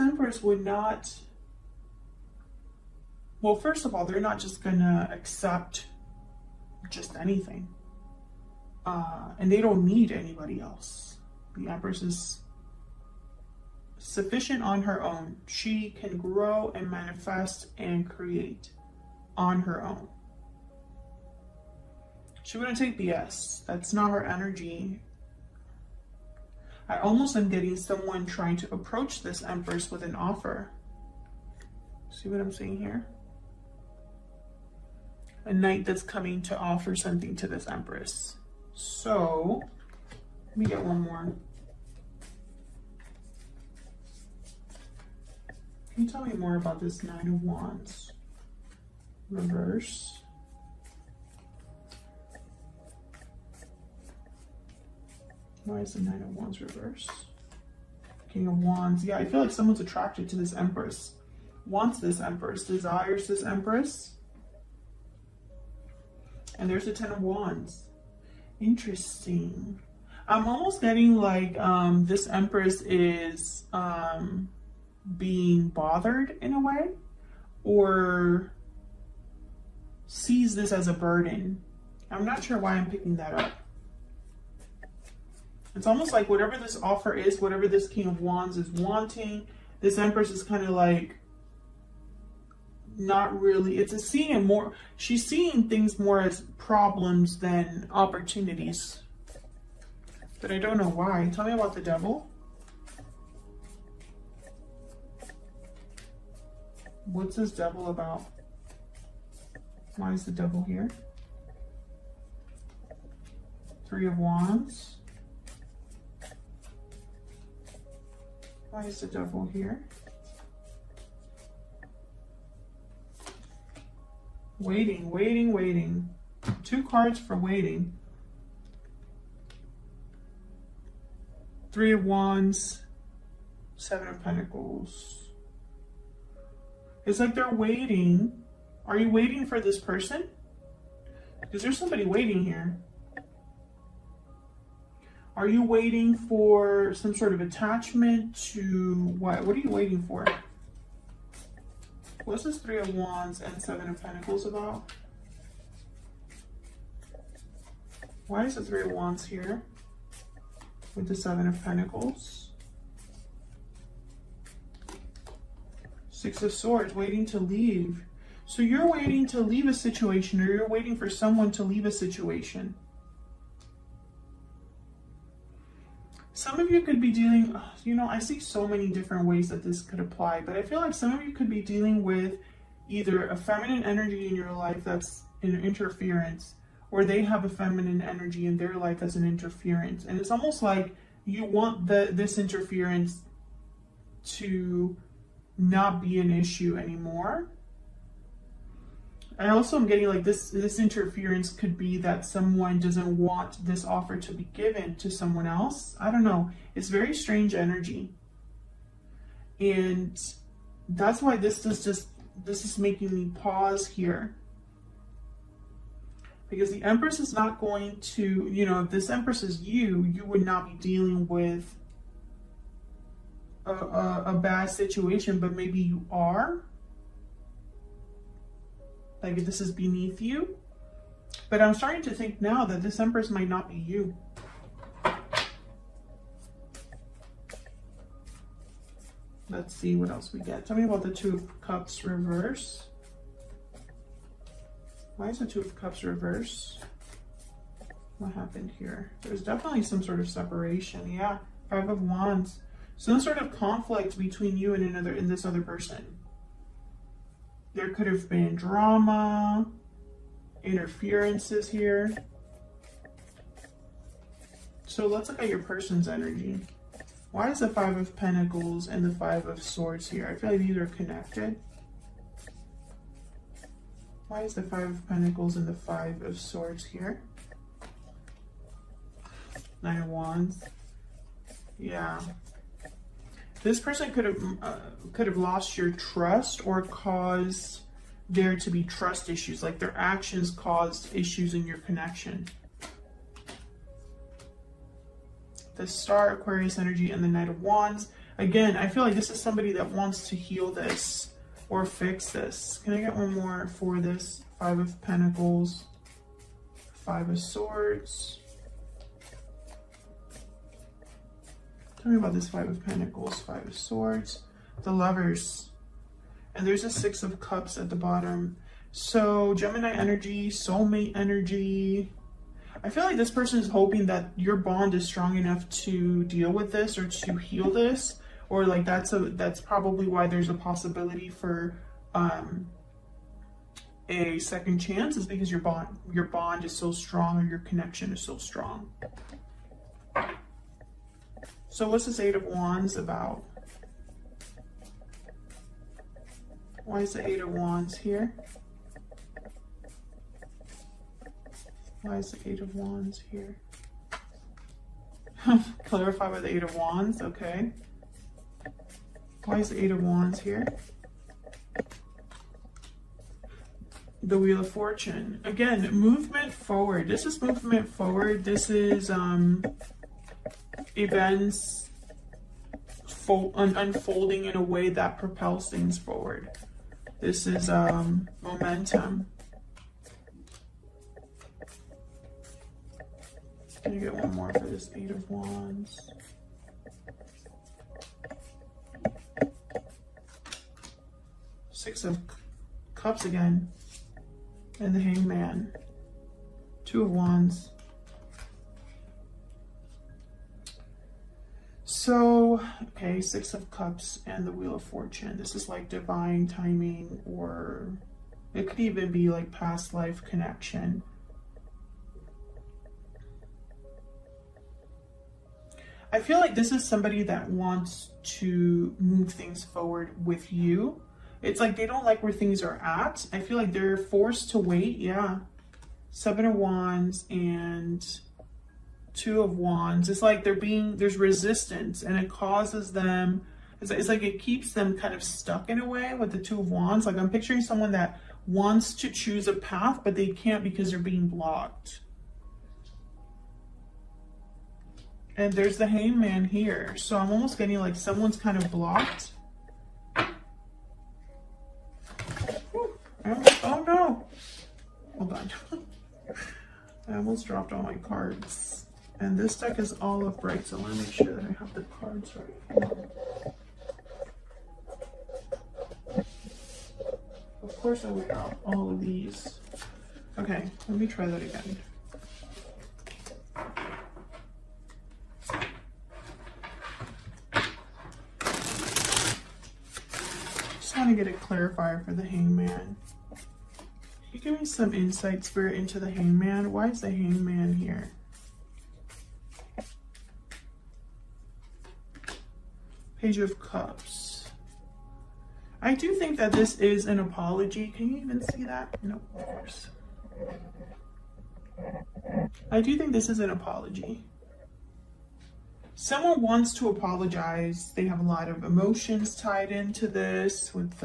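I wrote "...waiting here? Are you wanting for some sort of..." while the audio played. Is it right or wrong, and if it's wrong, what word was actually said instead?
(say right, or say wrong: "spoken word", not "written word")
wrong: "waiting", not "wanting".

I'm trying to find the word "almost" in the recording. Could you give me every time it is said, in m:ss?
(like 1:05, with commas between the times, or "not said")
0:26, 1:10, 1:25, 3:10, 7:27, 7:37.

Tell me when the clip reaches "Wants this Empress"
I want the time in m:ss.
1:01.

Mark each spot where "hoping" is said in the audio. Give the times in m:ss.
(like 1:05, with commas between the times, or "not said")
5:23.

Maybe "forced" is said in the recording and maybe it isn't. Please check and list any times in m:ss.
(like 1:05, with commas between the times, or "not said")
7:03.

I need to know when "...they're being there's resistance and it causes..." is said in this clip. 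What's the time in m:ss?
7:10.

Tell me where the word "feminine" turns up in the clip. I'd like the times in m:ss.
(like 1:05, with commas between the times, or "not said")
3:03, 3:07.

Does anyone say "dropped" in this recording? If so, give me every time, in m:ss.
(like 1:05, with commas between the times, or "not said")
7:37.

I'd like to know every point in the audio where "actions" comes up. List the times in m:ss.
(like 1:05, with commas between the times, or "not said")
4:49.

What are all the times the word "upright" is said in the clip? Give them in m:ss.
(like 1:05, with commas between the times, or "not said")
7:40.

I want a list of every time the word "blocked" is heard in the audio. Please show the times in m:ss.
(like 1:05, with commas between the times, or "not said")
7:21, 7:28.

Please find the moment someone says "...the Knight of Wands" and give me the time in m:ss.
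4:57.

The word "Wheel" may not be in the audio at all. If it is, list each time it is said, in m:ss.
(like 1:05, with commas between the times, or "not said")
6:04, 6:44.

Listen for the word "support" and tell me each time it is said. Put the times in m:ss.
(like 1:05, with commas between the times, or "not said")
not said.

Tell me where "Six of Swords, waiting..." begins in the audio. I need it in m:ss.
2:46.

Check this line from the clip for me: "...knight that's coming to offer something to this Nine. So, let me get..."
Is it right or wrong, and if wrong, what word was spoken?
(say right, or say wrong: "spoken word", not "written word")
wrong: "Empress", not "Nine".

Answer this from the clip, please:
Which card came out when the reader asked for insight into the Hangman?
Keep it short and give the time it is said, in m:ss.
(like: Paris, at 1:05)
Page of Cups, at 8:13.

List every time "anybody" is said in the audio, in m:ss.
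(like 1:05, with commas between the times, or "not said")
0:10.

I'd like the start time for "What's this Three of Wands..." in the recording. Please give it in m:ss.
2:32.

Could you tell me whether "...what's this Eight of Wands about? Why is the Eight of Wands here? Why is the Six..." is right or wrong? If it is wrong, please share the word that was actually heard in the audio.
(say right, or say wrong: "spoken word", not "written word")
wrong: "Eight", not "Six".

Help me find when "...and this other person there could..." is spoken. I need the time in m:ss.
4:15.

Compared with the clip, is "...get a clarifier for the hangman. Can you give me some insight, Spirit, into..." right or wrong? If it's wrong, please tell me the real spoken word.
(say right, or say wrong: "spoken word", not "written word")
right.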